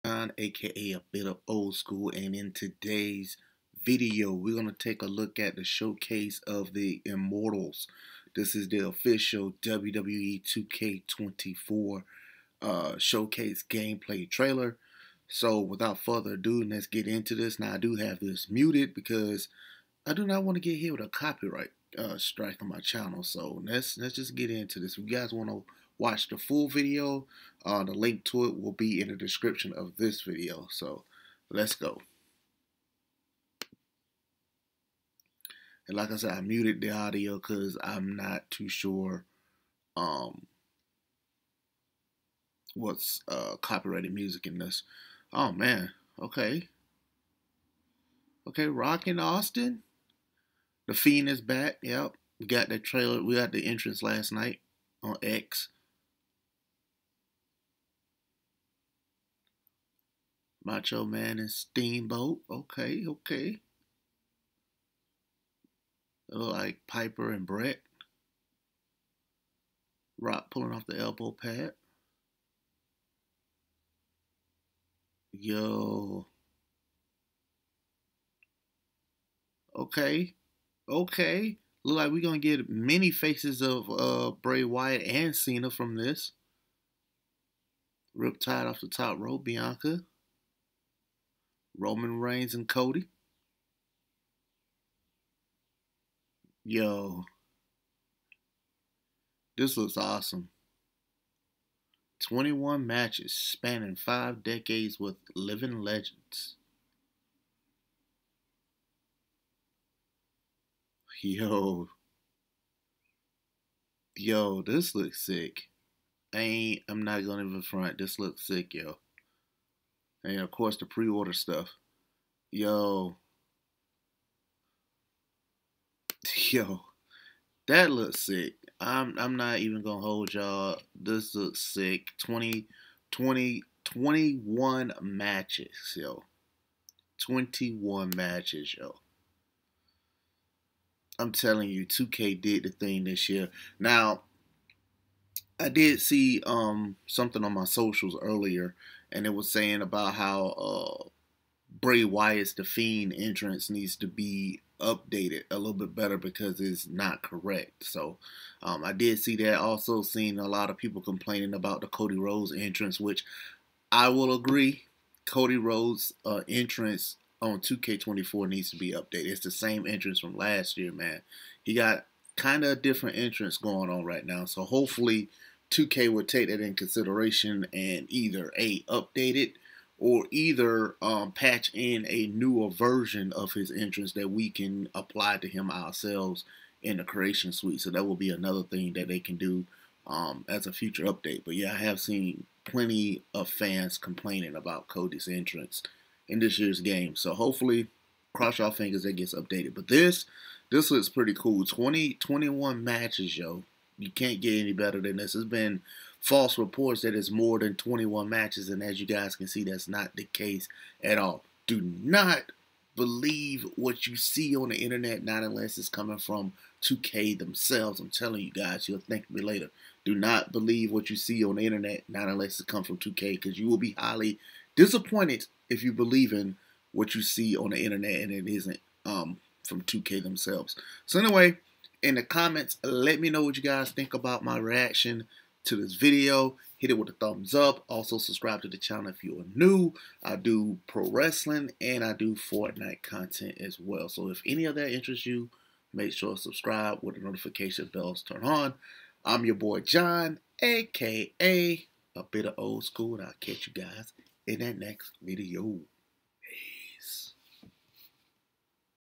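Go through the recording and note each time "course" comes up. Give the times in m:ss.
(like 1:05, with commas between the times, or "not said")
2:00.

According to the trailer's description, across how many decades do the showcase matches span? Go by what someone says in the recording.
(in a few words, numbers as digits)
5.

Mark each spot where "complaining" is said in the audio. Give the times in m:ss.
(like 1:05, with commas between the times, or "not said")
2:41, 3:13.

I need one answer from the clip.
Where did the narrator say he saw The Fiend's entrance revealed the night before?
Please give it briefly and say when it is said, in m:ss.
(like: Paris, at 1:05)
X, at 0:55.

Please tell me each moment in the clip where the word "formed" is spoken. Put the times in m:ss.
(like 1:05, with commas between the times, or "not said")
not said.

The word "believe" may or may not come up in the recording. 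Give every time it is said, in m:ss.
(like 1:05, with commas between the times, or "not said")
3:32, 3:40, 3:45.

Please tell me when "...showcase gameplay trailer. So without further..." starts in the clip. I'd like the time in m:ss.
0:12.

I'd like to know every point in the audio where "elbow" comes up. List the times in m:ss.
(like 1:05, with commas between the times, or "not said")
1:10.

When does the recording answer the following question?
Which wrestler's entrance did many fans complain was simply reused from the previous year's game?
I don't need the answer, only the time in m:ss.
2:41.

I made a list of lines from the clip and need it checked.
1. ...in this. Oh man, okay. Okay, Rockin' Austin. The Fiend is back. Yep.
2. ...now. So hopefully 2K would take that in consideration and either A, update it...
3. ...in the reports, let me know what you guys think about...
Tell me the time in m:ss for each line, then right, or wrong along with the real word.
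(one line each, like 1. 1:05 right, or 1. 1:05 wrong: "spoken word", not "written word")
1. 0:44 right
2. 2:54 right
3. 3:52 wrong: "comments", not "reports".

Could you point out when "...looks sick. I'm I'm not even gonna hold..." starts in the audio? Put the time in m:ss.
2:07.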